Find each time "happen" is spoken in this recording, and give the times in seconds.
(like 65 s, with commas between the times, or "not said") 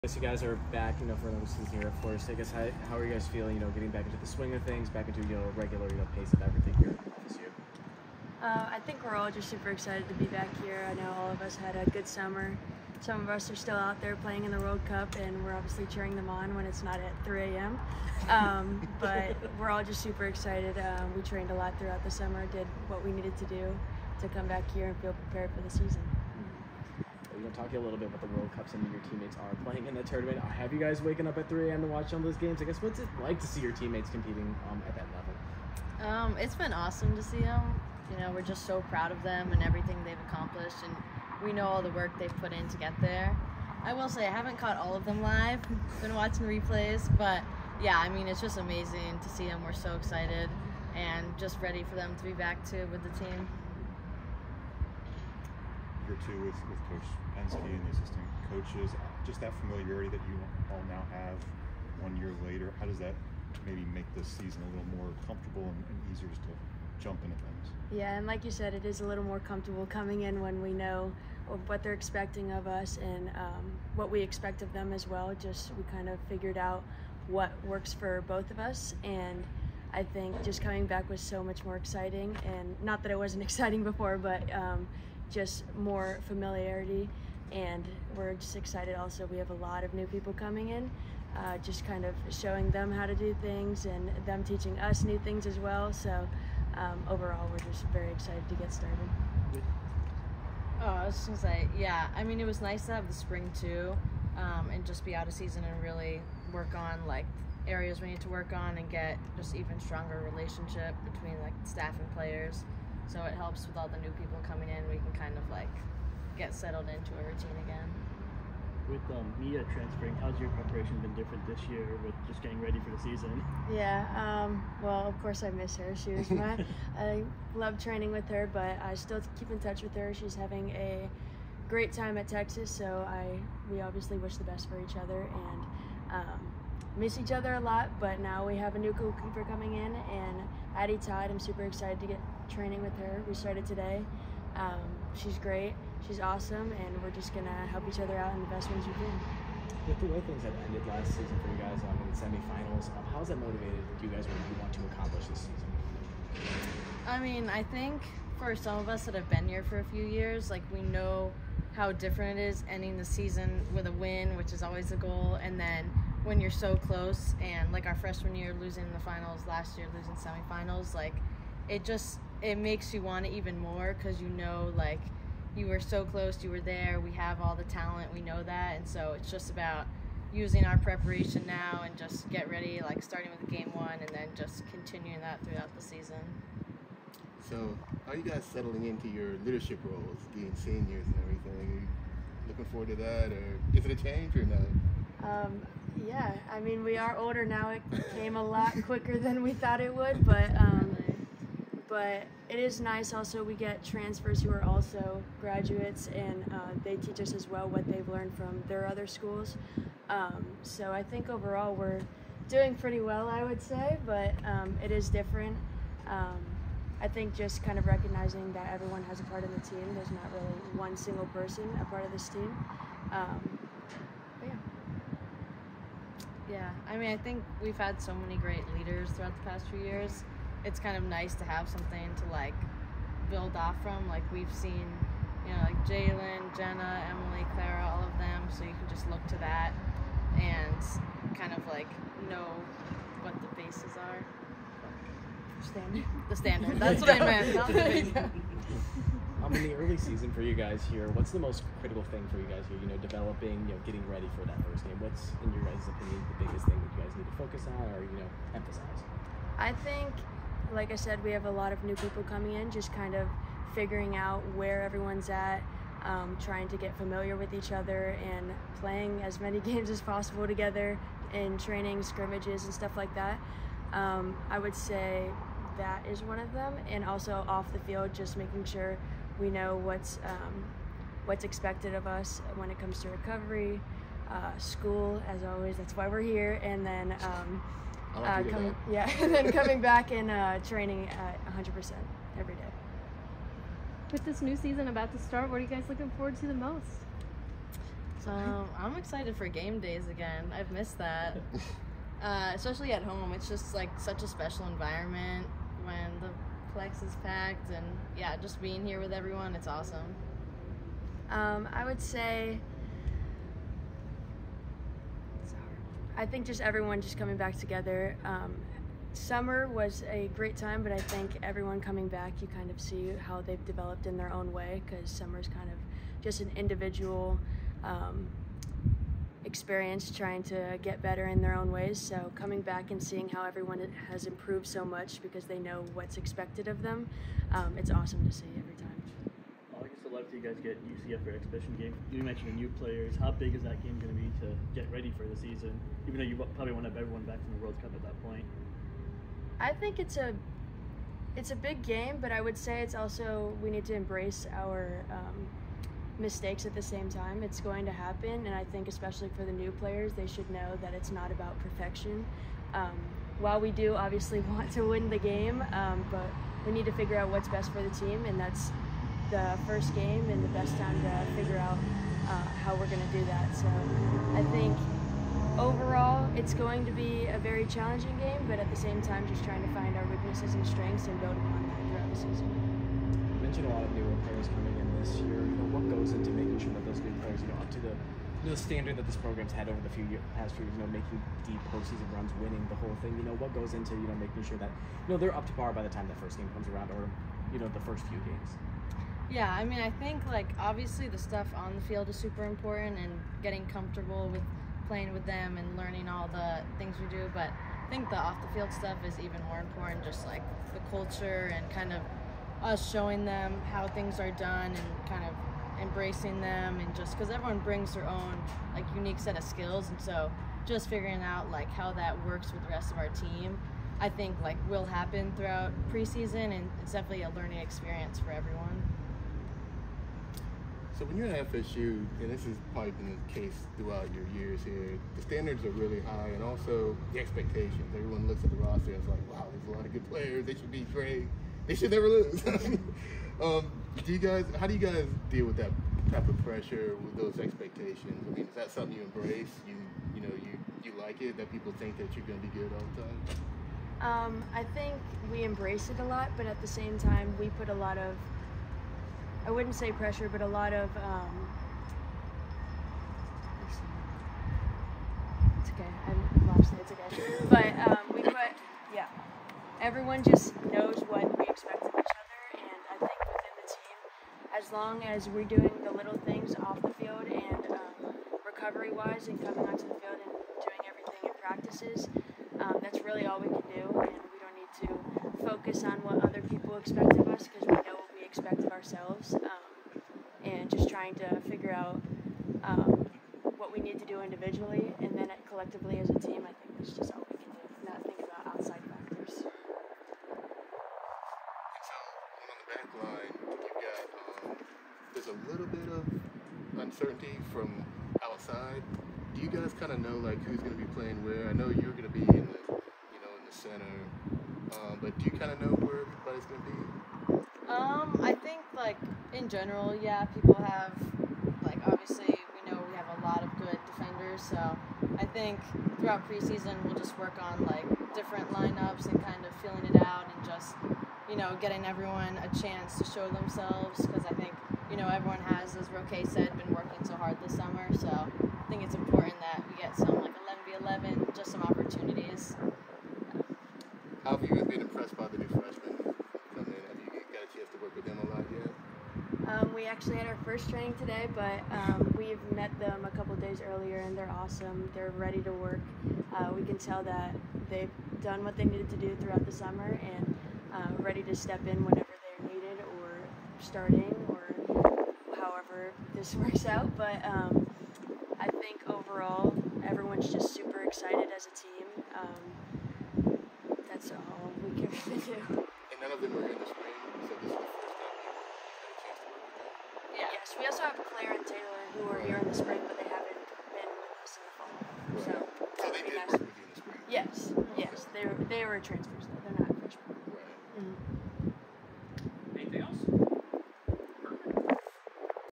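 357 s, 424 s.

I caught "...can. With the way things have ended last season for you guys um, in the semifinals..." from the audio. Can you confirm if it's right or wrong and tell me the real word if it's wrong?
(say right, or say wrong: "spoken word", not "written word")
right.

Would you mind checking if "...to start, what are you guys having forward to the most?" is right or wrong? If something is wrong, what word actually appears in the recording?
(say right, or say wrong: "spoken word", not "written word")
wrong: "looking", not "having".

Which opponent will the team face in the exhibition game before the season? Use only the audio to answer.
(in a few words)
UCF.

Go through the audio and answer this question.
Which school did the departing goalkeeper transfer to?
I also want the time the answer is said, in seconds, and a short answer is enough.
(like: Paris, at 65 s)
Texas, at 132 s.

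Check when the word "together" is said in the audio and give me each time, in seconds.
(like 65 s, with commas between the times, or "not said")
270 s, 317 s.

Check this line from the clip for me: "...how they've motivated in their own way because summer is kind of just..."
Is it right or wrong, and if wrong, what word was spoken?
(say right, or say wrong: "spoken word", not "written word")
wrong: "developed", not "motivated".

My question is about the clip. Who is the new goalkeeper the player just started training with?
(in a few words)
Addie Todd.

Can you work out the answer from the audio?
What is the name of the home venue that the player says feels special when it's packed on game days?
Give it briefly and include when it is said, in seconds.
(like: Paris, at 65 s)
The Plex, at 306 s.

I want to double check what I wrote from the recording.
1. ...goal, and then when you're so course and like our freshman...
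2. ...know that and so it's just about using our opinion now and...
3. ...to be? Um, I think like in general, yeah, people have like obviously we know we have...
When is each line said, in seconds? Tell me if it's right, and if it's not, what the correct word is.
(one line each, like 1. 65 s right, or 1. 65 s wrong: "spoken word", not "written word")
1. 164 s wrong: "close", not "course"
2. 178 s wrong: "preparation", not "opinion"
3. 516 s right.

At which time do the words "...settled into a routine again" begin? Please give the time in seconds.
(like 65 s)
116 s.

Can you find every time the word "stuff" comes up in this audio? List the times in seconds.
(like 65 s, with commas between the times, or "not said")
272 s, 401 s, 408 s.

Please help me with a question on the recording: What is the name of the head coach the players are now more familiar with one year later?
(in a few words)
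Coach Pensky.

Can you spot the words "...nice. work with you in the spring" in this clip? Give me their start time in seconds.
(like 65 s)
586 s.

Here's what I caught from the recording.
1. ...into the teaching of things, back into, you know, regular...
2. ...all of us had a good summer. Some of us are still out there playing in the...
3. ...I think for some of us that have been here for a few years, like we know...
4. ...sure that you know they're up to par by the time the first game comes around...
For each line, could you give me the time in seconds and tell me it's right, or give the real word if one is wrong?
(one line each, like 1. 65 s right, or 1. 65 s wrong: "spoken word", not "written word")
1. 4 s wrong: "swing", not "teaching"
2. 11 s right
3. 157 s right
4. 394 s right.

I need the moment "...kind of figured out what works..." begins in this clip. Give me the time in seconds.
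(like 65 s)
75 s.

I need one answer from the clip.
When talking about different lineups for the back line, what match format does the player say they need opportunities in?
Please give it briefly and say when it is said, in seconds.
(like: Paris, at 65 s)
11v11, at 540 s.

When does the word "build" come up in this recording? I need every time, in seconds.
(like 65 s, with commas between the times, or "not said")
233 s, 381 s.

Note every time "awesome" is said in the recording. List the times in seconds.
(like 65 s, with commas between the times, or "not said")
36 s, 146 s, 309 s, 337 s, 554 s.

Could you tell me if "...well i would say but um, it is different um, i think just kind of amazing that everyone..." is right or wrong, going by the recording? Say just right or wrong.
wrong.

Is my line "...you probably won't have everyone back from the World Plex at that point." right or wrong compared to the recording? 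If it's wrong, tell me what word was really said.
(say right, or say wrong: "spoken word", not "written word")
wrong: "Cup", not "Plex".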